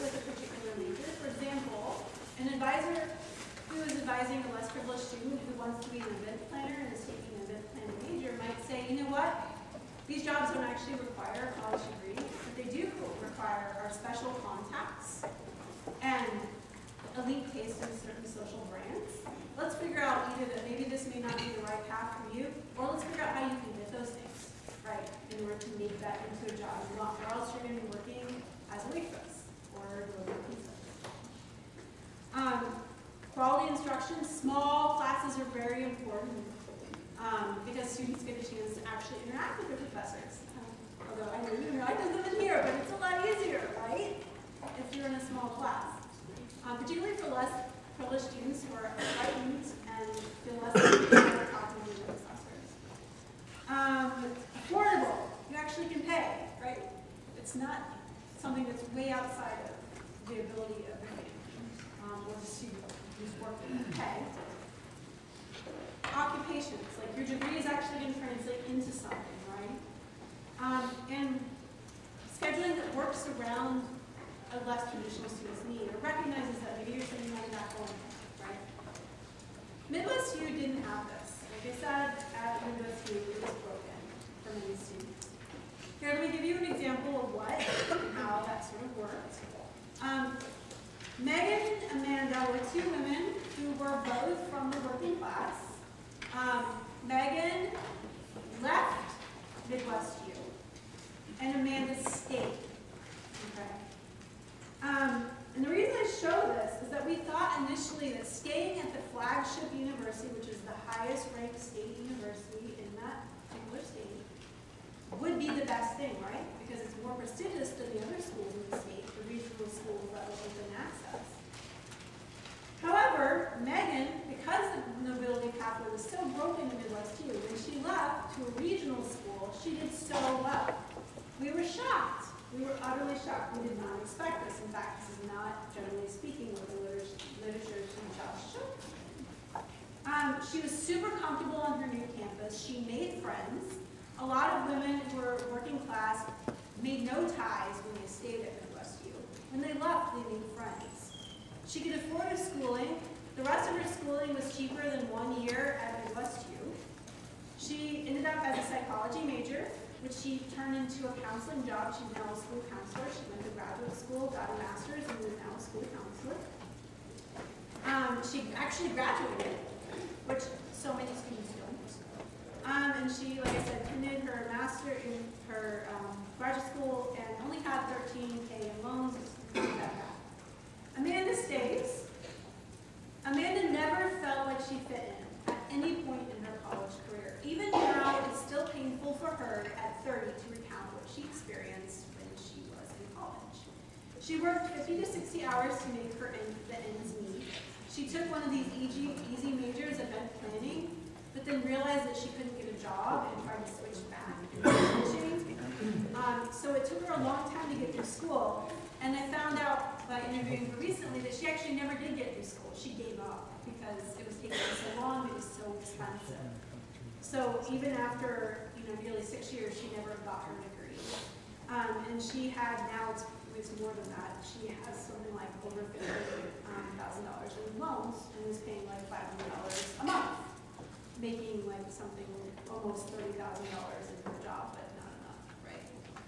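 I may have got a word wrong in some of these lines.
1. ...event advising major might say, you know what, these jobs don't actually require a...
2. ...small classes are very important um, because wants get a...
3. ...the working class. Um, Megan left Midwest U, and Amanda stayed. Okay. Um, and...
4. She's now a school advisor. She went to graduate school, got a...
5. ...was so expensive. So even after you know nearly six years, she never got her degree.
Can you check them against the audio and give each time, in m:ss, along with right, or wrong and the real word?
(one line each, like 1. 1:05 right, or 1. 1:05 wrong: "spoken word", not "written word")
1. 0:07 wrong: "planning", not "advising"
2. 0:34 wrong: "students", not "wants"
3. 1:34 right
4. 2:41 wrong: "counselor", not "advisor"
5. 3:35 right.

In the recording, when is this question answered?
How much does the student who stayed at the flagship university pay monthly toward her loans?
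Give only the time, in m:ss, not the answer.
3:49.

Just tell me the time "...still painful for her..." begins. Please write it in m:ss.
3:08.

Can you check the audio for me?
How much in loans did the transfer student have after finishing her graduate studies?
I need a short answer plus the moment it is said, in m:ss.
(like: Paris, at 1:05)
$13K, at 2:57.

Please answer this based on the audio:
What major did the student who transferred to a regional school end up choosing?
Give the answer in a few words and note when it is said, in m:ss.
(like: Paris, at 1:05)
psychology, at 2:38.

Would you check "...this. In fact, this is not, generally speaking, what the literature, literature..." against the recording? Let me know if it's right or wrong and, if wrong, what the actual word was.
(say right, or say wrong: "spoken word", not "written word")
right.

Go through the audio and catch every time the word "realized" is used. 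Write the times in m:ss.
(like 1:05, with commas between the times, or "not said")
3:21.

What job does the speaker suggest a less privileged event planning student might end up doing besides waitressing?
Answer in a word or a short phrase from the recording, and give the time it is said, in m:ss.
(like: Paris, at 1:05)
delivering pizza, at 0:30.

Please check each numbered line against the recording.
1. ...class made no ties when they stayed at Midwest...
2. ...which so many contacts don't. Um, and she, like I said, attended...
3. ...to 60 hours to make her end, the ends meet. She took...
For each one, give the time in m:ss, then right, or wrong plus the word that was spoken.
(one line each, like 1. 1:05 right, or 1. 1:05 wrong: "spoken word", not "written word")
1. 2:25 right
2. 2:50 wrong: "students", not "contacts"
3. 3:14 right.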